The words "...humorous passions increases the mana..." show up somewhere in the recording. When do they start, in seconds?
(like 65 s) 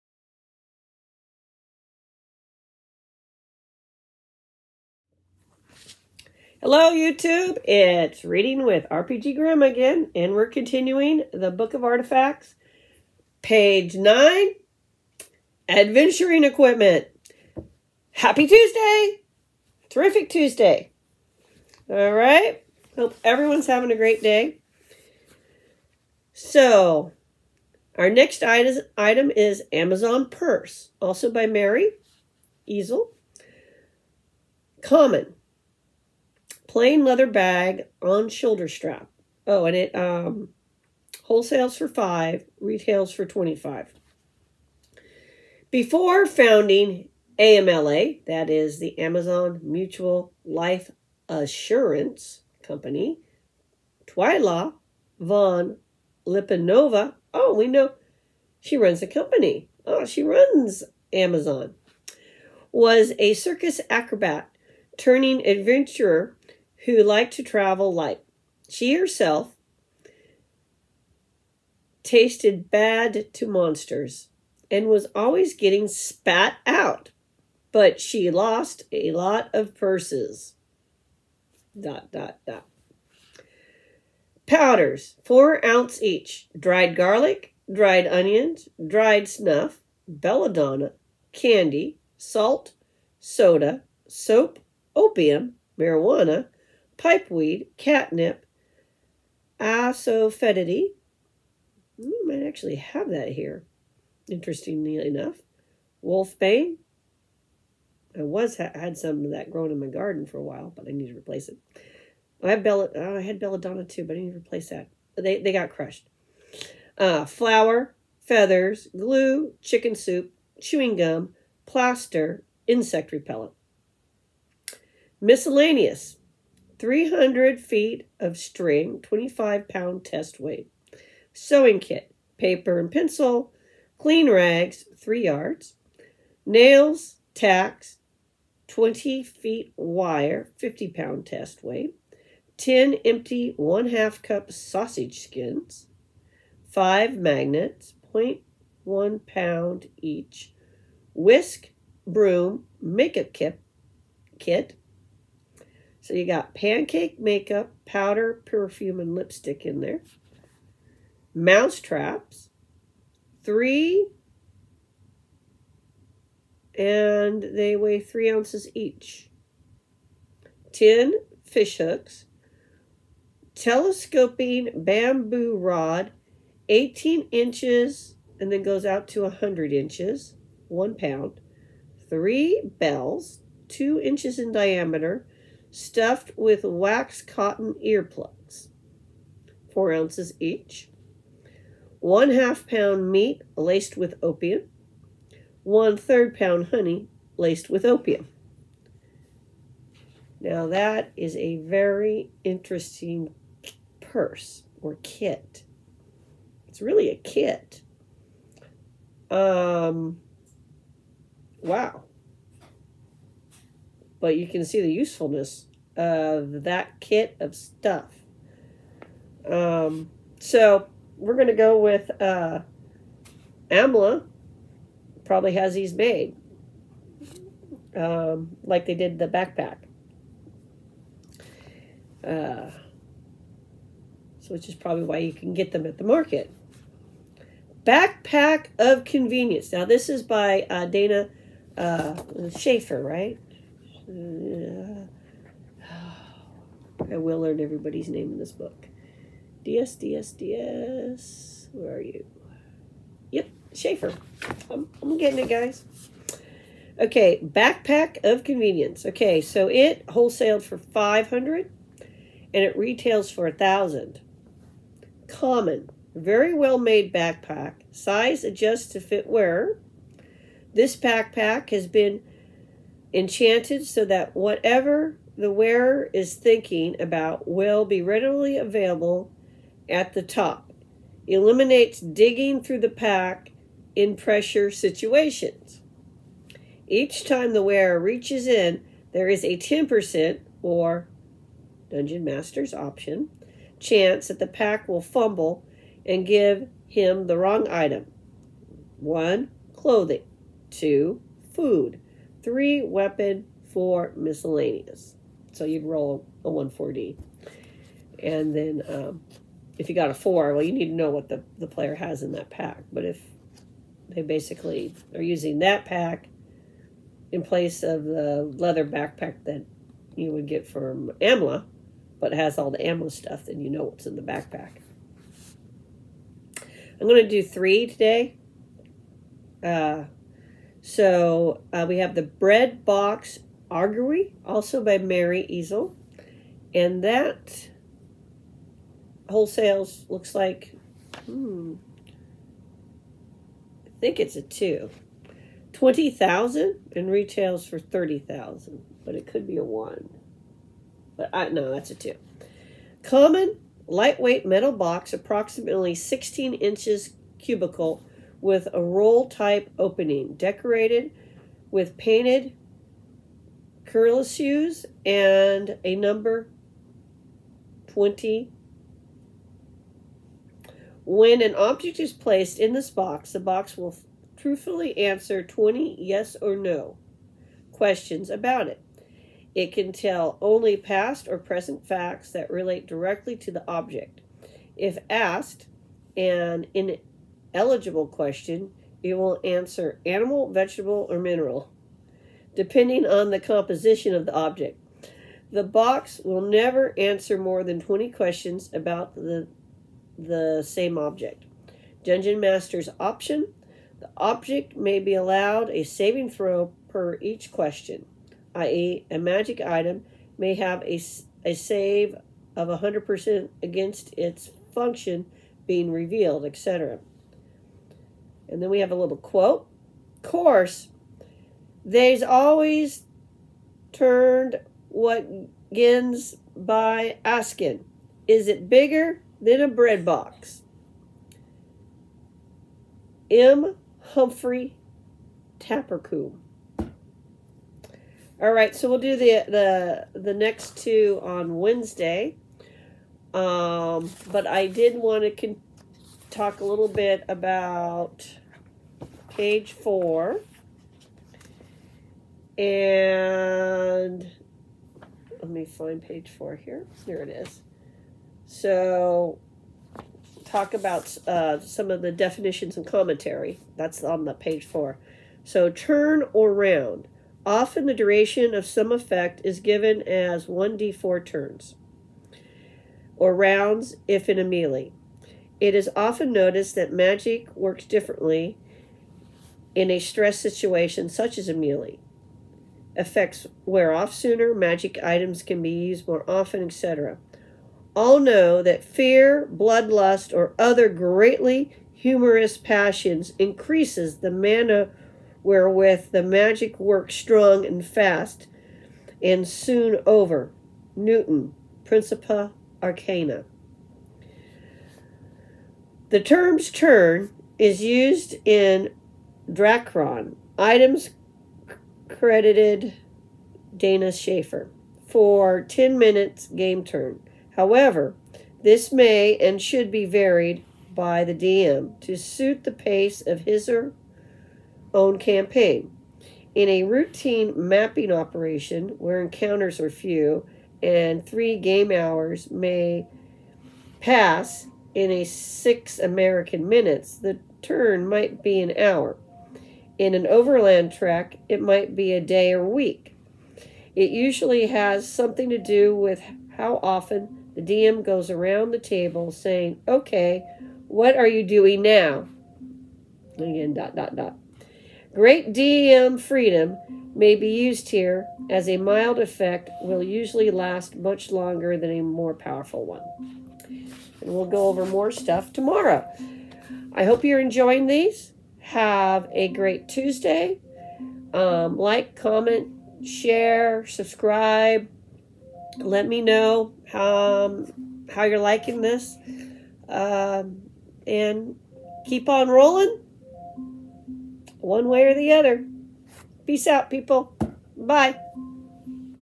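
491 s.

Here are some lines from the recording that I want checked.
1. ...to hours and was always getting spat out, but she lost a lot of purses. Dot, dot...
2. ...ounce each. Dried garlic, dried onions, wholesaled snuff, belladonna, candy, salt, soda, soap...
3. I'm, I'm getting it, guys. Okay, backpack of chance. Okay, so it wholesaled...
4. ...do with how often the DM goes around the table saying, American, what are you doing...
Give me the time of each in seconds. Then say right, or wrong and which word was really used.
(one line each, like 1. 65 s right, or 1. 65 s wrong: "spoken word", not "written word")
1. 73 s wrong: "monsters", not "hours"
2. 85 s wrong: "dried", not "wholesaled"
3. 254 s wrong: "convenience", not "chance"
4. 545 s wrong: "Okay", not "American".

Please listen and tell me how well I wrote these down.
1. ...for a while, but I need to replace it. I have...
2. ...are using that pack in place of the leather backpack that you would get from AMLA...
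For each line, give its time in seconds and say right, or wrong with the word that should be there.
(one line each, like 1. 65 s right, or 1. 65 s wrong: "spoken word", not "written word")
1. 110 s right
2. 315 s right.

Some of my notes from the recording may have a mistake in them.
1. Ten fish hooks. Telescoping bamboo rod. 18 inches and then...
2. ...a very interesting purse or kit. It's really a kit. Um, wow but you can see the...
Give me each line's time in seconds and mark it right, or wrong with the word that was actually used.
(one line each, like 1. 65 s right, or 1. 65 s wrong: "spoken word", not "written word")
1. 170 s right
2. 201 s right.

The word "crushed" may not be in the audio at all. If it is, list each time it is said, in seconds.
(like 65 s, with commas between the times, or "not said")
115 s.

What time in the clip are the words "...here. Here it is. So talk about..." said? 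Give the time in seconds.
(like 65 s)
456 s.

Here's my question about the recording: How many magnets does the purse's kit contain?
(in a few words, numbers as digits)
5.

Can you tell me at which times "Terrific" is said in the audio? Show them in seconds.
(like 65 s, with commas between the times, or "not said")
19 s.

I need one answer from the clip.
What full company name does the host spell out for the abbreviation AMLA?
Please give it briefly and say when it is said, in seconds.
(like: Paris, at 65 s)
Amazon Mutual Life Assurance Company, at 48 s.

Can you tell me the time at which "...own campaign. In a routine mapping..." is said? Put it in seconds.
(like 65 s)
524 s.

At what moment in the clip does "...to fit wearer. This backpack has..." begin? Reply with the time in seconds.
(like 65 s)
268 s.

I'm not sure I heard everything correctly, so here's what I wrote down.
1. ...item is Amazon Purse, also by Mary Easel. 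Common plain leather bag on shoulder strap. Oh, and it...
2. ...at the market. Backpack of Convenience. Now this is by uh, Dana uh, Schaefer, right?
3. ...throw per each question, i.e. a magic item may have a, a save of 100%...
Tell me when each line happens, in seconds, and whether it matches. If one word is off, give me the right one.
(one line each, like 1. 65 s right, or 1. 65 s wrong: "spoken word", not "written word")
1. 28 s right
2. 235 s right
3. 406 s right.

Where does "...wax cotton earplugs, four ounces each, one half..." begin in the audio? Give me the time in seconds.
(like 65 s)
186 s.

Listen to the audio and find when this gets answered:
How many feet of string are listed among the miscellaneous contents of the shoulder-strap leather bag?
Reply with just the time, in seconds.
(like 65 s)
126 s.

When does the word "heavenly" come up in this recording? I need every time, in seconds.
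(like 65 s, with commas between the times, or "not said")
not said.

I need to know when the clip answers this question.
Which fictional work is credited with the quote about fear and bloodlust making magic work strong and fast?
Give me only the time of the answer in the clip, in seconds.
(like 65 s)
501 s.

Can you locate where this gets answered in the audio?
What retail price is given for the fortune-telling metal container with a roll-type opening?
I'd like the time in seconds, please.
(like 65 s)
347 s.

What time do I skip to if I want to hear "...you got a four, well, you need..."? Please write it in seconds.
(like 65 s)
309 s.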